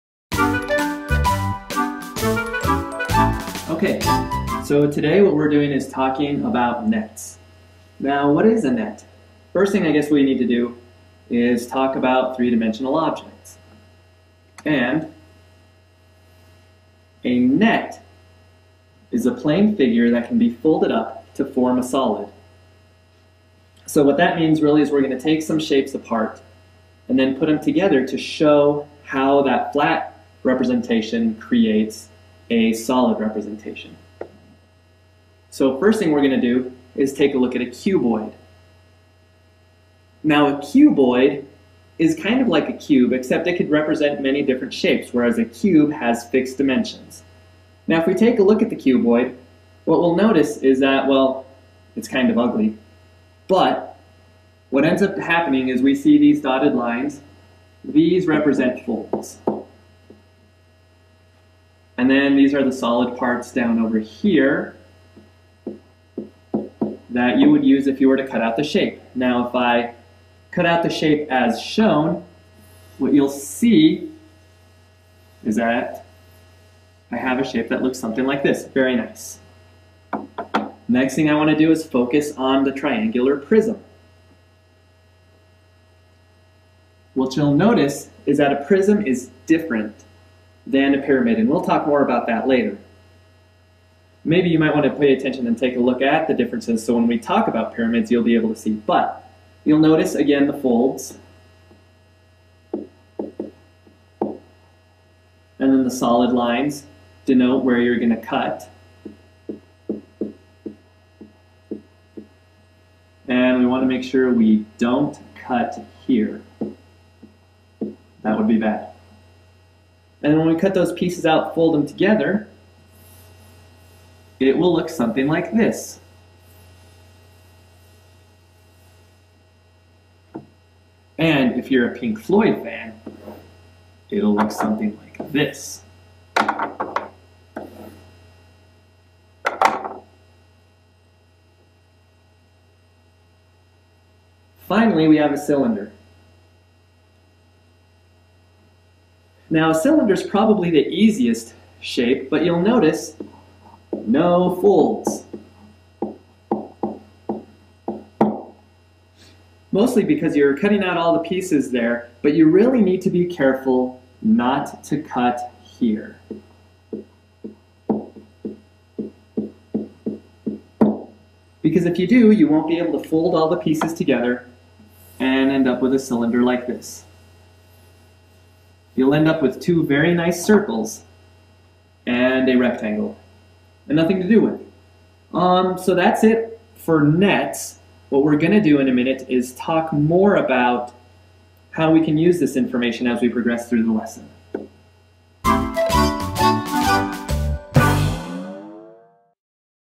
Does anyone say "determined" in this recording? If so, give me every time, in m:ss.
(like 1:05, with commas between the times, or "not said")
not said.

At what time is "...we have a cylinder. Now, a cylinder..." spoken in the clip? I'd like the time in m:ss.
2:25.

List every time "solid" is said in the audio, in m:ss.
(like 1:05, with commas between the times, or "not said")
0:21, 0:32, 1:02, 1:45.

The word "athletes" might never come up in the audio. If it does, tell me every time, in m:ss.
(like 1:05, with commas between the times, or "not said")
not said.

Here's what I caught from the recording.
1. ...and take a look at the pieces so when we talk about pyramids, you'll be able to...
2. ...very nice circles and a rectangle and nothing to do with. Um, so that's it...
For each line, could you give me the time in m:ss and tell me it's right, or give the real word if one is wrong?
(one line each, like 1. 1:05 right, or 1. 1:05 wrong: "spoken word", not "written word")
1. 1:35 wrong: "differences", not "pieces"
2. 2:59 right.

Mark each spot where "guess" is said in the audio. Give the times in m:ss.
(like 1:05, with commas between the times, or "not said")
0:09.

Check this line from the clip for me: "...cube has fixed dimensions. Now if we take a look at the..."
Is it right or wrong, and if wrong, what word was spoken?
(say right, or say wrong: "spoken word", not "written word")
right.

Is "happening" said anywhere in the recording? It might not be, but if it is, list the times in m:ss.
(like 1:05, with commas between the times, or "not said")
0:55.